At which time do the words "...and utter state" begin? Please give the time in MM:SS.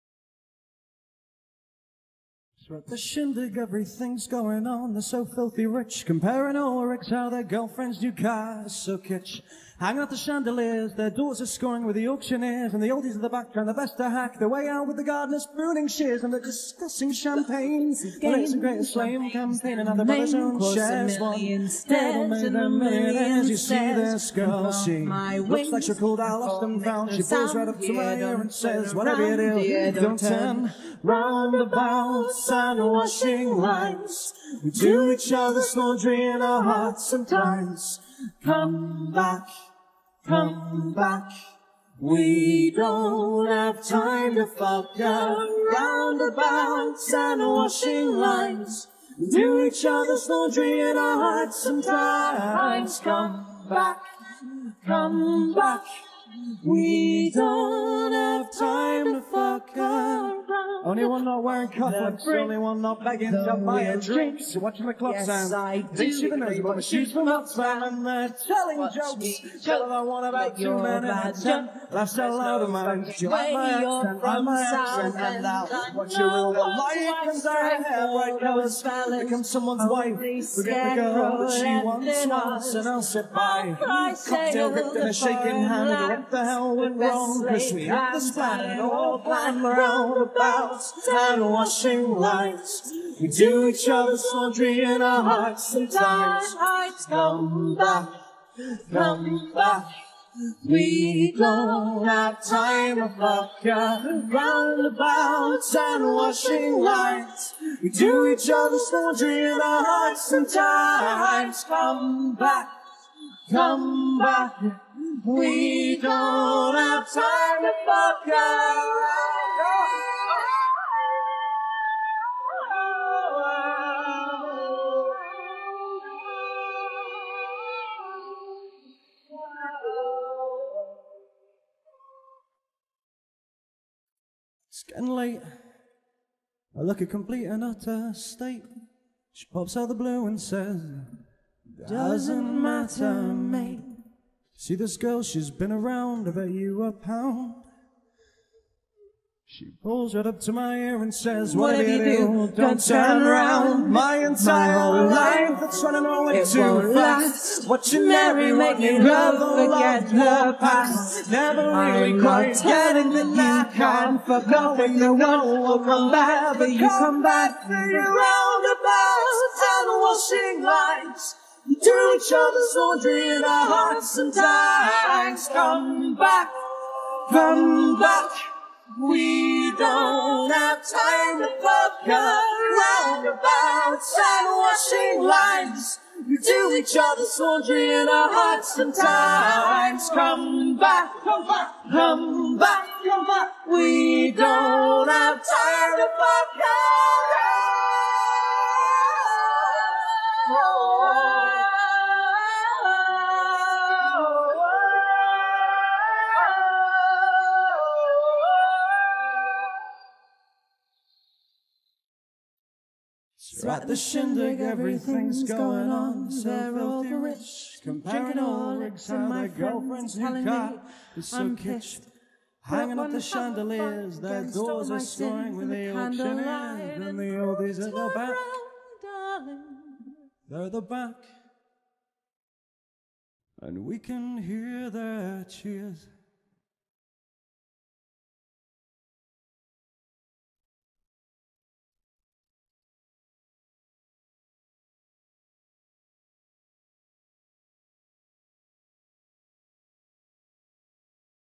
02:17.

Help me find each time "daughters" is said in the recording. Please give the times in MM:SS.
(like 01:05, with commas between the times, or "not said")
00:11.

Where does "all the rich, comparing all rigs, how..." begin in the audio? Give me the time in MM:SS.
03:36.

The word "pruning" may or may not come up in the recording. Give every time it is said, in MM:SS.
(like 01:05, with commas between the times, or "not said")
00:15.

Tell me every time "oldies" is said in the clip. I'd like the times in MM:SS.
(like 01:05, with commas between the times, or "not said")
00:12, 03:47.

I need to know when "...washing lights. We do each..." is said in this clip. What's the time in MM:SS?
01:46.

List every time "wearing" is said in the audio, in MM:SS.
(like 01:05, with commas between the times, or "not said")
01:01.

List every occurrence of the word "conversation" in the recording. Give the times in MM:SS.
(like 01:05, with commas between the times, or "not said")
not said.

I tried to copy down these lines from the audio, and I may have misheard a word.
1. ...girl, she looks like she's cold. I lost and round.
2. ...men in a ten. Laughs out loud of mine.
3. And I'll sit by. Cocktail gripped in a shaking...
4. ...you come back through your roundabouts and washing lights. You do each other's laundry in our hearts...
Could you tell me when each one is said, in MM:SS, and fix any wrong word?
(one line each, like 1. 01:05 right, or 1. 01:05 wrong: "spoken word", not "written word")
1. 00:24 wrong: "found", not "round"
2. 01:10 right
3. 01:22 right
4. 02:46 right.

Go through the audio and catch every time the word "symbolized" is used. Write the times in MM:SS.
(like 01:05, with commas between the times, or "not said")
not said.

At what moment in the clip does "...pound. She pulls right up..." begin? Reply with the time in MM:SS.
02:26.